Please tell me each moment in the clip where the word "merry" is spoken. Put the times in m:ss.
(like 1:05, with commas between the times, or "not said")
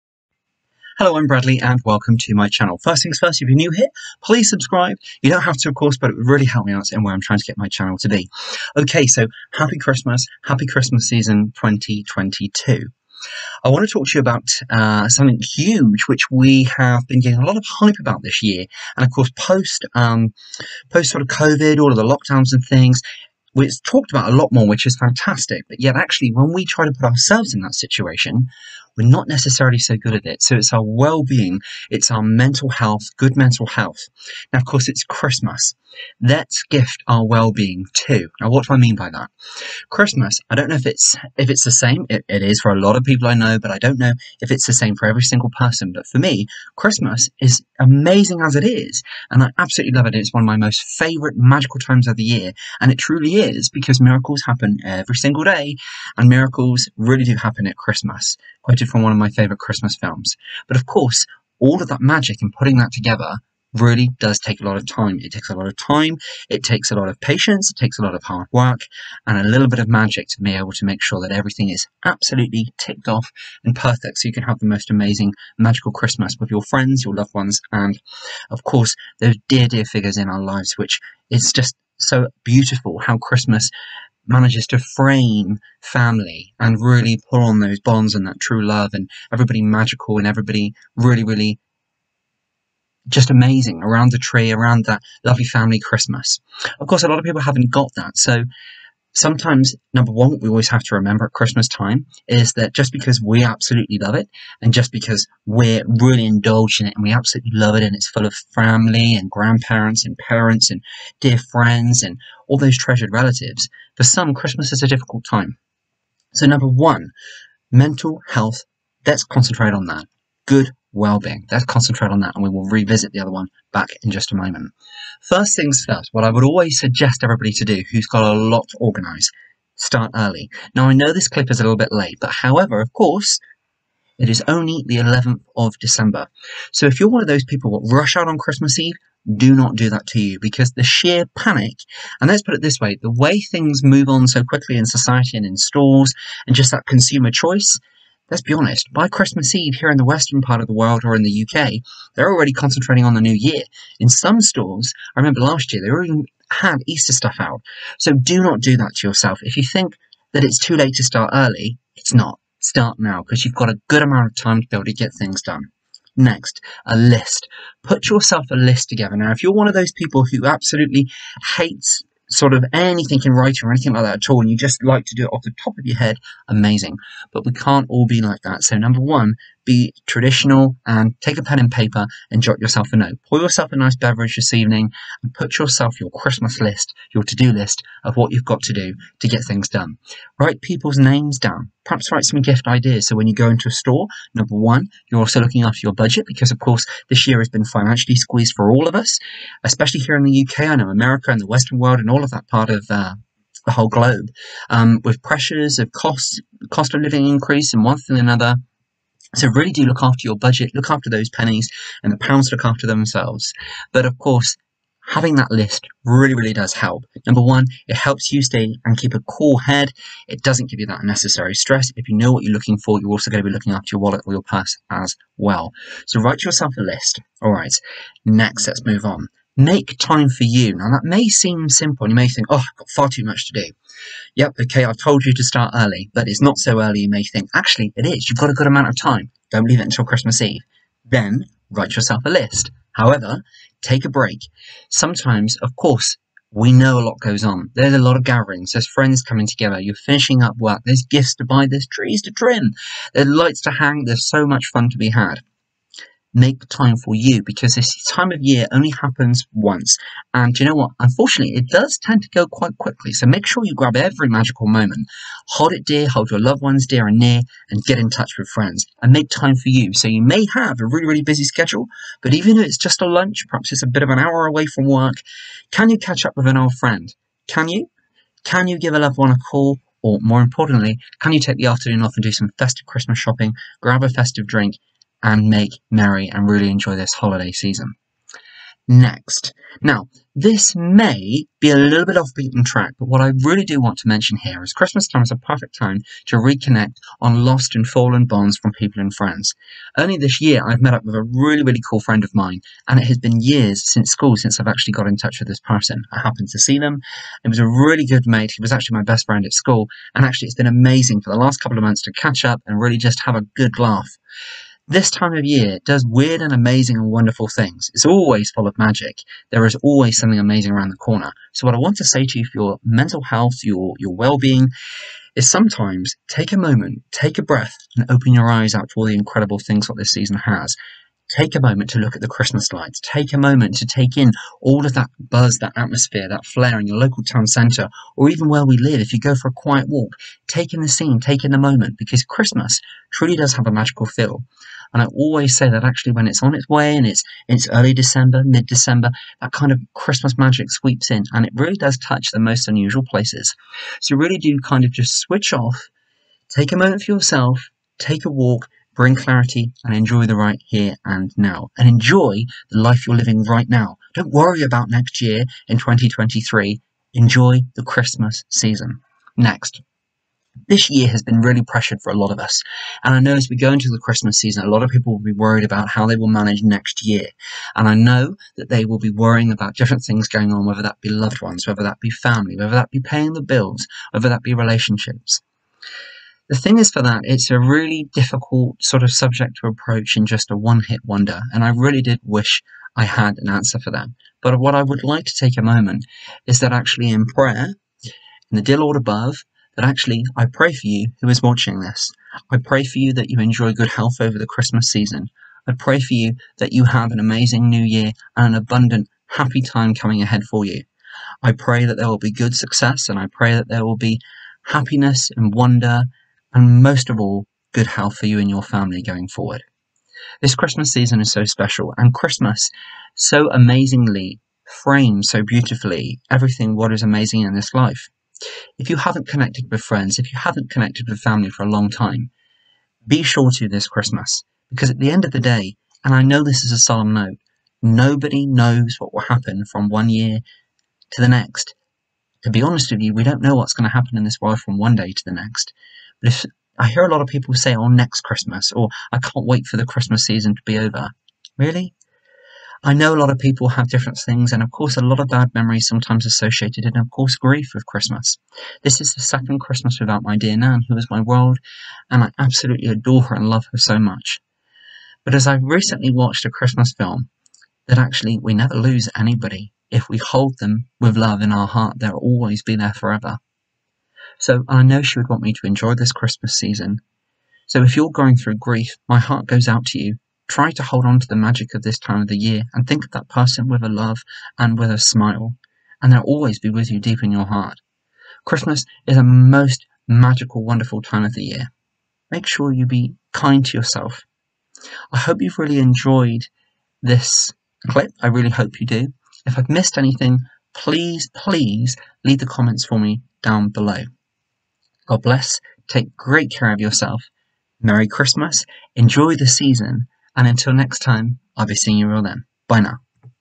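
4:45, 8:27.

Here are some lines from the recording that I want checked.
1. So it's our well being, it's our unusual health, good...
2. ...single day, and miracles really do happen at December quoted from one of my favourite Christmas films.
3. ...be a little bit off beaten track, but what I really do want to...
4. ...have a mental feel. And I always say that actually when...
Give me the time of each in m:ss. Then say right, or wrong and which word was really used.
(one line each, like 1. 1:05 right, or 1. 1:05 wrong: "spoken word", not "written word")
1. 0:30 wrong: "mental", not "unusual"
2. 0:55 wrong: "Christmas", not "December"
3. 4:51 right
4. 5:43 wrong: "magical", not "mental".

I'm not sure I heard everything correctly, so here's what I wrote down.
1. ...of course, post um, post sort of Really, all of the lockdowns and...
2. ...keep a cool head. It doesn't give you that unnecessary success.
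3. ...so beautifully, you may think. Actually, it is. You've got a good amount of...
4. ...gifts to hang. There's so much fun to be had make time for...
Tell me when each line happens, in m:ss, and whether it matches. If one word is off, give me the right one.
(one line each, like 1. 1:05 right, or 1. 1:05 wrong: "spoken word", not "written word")
1. 0:19 wrong: "COVID", not "Really"
2. 3:38 wrong: "stress", not "success"
3. 3:56 wrong: "early", not "beautifully"
4. 4:13 wrong: "lights", not "gifts".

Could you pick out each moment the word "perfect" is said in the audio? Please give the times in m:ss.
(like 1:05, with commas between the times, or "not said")
1:13, 4:55.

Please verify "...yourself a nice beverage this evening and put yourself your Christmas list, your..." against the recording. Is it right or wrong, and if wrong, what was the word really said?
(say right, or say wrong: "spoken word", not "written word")
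right.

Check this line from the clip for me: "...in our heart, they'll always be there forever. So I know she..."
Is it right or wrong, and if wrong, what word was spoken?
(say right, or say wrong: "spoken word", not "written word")
right.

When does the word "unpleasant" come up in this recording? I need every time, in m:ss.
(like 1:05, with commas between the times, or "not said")
not said.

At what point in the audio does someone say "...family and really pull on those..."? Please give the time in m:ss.
1:25.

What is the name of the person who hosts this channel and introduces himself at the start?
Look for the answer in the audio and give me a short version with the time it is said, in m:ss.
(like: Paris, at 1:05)
Bradley, at 0:01.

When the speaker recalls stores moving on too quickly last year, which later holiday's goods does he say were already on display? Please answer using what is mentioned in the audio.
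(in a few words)
Easter.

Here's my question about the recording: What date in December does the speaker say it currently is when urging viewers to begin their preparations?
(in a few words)
11th of December.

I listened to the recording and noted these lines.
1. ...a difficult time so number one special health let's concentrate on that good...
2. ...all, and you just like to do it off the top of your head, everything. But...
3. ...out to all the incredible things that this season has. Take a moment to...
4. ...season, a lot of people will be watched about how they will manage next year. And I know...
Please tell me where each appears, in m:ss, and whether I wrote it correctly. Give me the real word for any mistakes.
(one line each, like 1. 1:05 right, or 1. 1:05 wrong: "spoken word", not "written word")
1. 1:54 wrong: "mental", not "special"
2. 2:54 wrong: "amazing", not "everything"
3. 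5:28 right
4. 6:14 wrong: "worried", not "watched".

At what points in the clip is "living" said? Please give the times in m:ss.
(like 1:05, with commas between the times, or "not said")
3:27, 6:03.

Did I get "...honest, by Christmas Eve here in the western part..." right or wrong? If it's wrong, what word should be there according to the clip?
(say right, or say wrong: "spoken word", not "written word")
right.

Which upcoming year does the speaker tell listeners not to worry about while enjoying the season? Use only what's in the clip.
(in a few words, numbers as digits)
2023.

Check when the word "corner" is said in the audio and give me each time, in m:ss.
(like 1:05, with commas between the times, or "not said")
5:20.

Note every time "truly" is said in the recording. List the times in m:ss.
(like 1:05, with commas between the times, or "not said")
0:52, 5:43.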